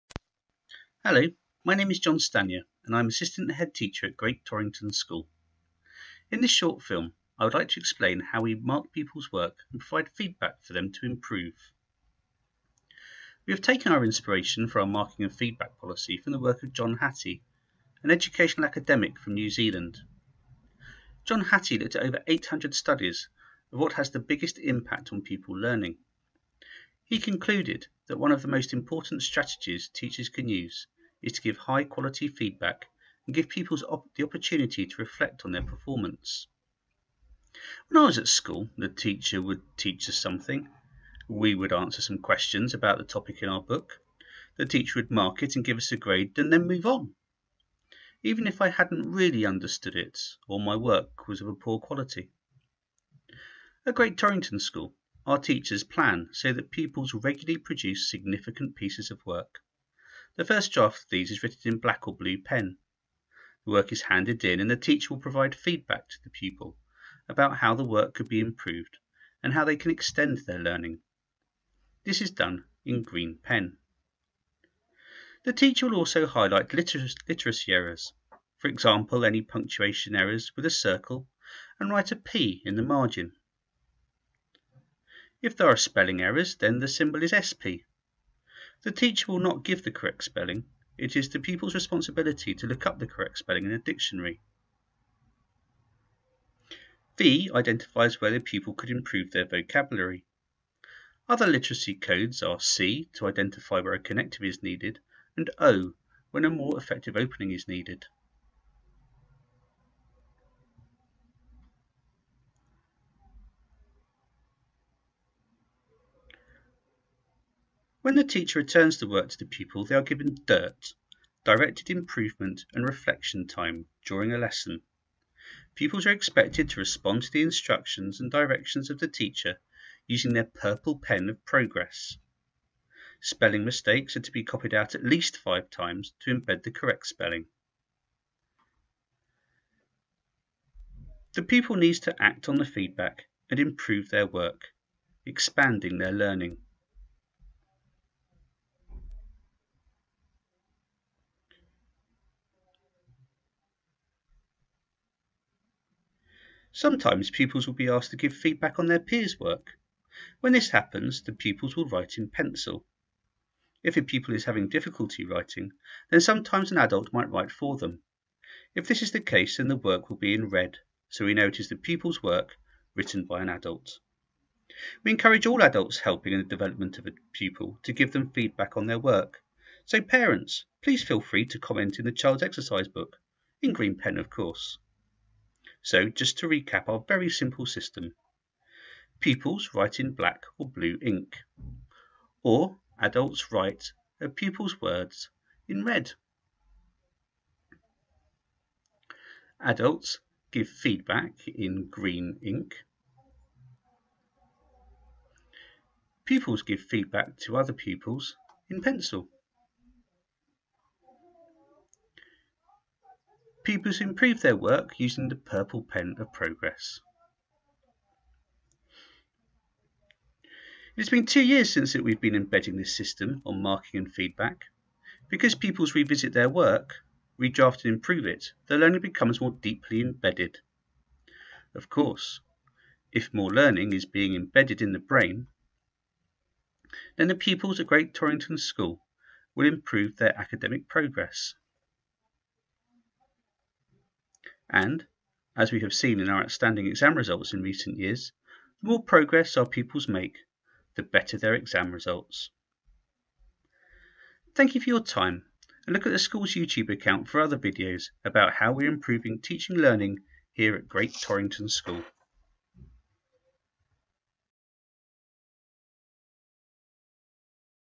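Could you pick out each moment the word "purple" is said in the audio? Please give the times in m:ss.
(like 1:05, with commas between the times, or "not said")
2:10, 3:35.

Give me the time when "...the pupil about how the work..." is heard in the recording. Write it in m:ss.
1:06.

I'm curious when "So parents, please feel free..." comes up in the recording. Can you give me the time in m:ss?
2:59.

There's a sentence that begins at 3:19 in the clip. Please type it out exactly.
Adults give feedback in green ink.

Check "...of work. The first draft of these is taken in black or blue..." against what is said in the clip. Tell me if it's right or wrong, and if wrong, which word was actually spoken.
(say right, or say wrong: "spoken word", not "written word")
wrong: "written", not "taken".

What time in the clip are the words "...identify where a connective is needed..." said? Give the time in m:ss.
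1:43.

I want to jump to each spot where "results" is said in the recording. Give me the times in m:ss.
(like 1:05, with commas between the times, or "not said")
4:07, 4:11.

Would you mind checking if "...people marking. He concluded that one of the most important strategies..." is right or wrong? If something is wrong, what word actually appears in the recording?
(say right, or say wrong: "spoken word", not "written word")
wrong: "learning", not "marking".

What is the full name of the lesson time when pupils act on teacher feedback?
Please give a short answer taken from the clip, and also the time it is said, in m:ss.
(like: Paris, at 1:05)
Directed improvement and reflection time, at 2:01.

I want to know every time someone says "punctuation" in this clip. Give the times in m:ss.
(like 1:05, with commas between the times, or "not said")
1:19.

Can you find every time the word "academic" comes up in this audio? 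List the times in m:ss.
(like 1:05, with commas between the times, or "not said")
0:18, 4:00.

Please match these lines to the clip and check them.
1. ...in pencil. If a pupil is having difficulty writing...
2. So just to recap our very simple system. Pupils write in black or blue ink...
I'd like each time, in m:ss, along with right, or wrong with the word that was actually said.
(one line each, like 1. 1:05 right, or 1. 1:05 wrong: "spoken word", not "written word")
1. 2:42 right
2. 3:05 right.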